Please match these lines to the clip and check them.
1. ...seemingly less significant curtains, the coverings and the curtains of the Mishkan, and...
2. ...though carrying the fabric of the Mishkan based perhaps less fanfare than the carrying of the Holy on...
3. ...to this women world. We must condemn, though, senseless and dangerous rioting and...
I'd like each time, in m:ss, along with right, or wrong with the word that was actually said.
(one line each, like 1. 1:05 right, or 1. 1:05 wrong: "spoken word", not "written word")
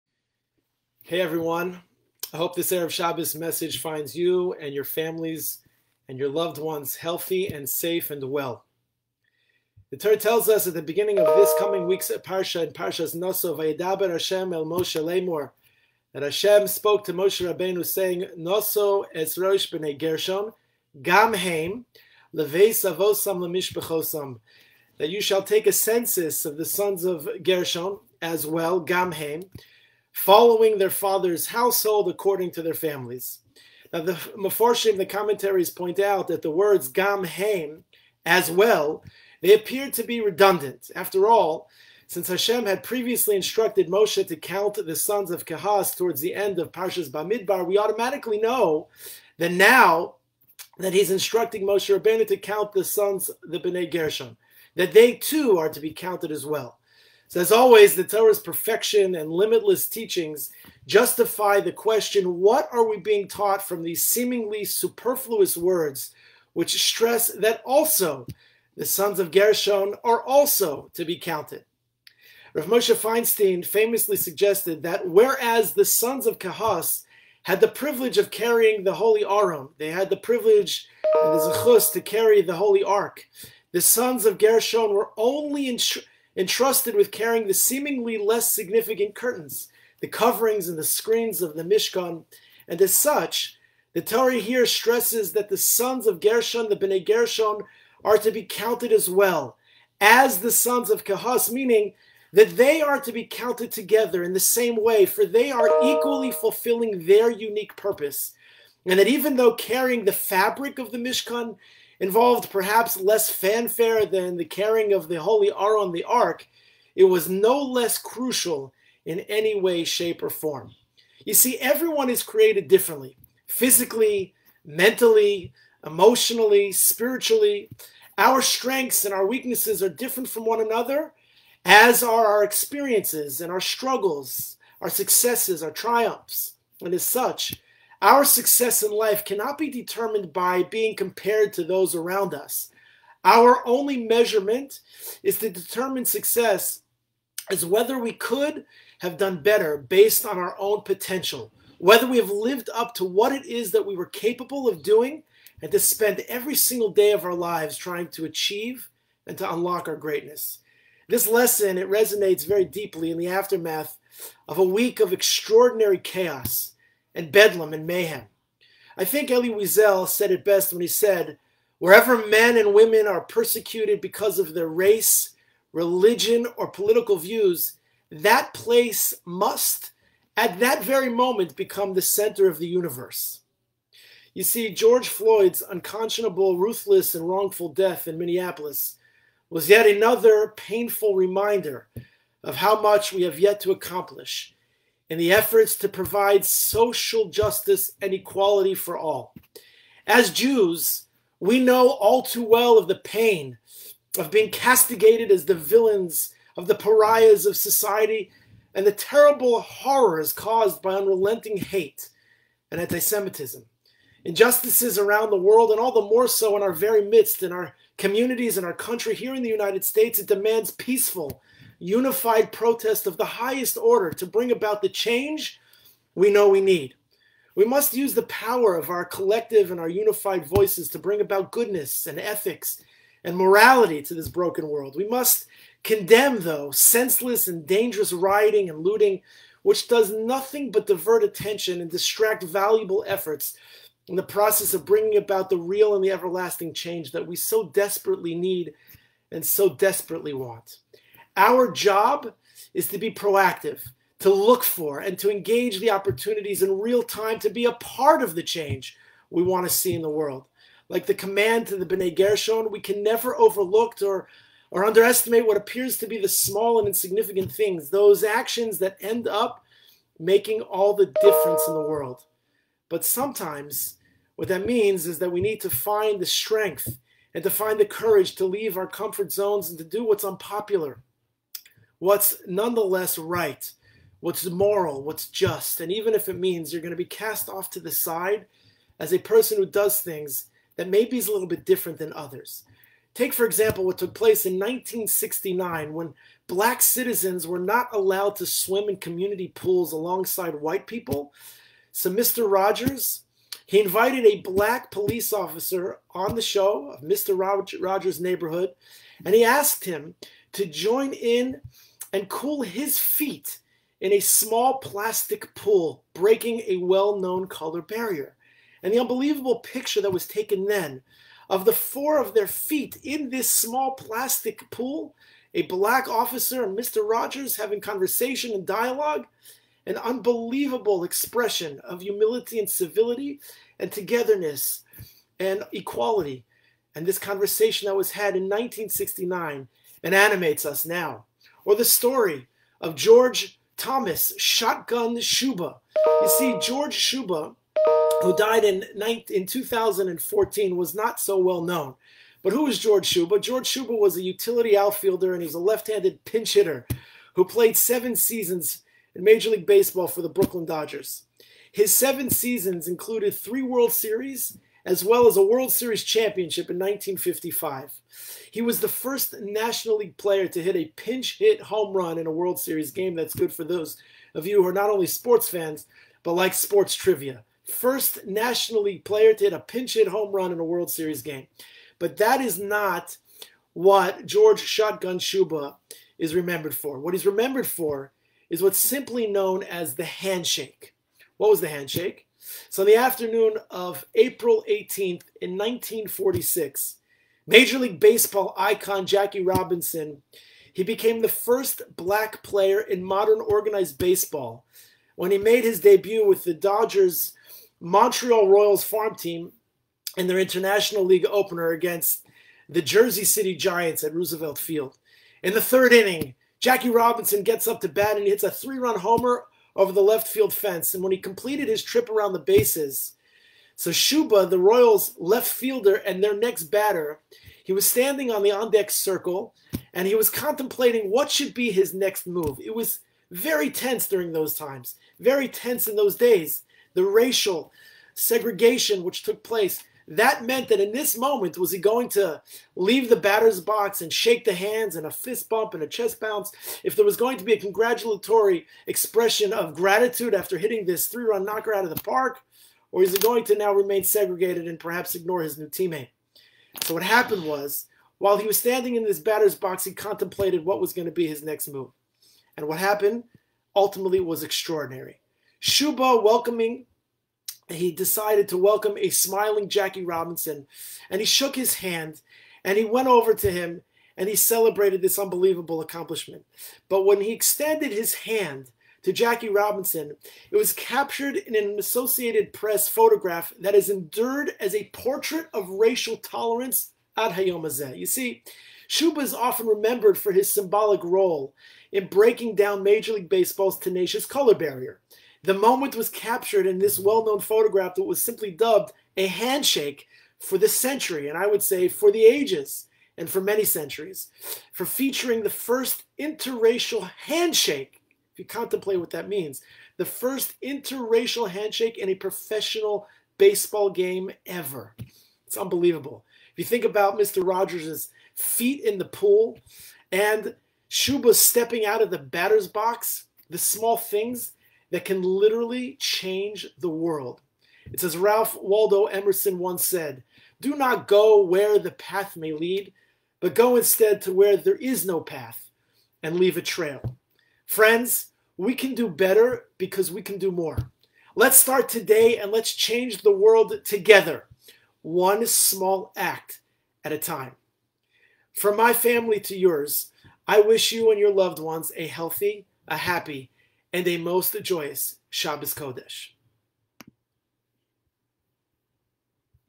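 1. 1:27 wrong: "screens", not "curtains"
2. 1:49 wrong: "involved", not "based"
3. 3:54 wrong: "broken", not "women".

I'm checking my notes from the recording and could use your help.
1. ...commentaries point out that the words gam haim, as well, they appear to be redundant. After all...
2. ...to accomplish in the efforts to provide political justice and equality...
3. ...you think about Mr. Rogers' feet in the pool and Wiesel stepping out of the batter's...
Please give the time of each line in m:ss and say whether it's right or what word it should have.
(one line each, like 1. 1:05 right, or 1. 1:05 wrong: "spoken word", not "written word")
1. 0:35 right
2. 3:13 wrong: "social", not "political"
3. 8:36 wrong: "Shuba", not "Wiesel".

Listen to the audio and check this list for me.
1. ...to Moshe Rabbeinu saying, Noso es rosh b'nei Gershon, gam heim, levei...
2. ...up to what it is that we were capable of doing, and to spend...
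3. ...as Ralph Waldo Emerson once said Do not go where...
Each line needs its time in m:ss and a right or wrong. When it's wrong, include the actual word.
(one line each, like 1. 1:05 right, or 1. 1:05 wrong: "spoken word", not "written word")
1. 0:17 right
2. 2:32 right
3. 8:48 right.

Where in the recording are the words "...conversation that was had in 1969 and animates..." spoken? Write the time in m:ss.
5:37.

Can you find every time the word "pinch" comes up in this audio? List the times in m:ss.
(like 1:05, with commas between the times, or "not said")
5:56, 6:10, 6:19.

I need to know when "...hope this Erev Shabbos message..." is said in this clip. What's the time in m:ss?
0:02.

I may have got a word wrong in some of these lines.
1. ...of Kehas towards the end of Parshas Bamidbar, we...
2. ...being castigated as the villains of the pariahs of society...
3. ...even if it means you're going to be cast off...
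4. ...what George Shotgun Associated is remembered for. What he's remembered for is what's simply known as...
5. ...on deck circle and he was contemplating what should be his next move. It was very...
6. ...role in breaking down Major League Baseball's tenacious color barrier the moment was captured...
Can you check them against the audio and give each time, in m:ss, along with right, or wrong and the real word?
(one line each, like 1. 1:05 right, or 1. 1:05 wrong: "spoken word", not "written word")
1. 0:45 right
2. 3:24 right
3. 4:45 right
4. 6:23 wrong: "Shuba", not "Associated"
5. 7:08 right
6. 8:11 right.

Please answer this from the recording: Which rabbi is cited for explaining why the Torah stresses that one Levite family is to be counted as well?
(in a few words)
Rav Moshe Feinstein.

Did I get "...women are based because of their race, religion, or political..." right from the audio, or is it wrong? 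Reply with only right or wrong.
wrong.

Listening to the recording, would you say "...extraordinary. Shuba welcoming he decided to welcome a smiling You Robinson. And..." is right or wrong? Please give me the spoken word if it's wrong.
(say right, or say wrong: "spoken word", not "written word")
wrong: "Jackie", not "You".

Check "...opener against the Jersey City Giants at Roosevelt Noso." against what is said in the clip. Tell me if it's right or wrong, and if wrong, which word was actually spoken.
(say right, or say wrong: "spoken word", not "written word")
wrong: "Field", not "Noso".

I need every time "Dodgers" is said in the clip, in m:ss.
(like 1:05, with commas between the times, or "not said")
6:00, 6:46.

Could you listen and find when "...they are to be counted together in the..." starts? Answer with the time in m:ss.
1:42.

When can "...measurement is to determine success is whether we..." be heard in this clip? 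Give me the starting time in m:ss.
2:24.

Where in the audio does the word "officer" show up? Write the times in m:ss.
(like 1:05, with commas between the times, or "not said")
5:05, 5:26.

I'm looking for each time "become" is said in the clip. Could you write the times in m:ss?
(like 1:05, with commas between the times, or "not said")
3:01.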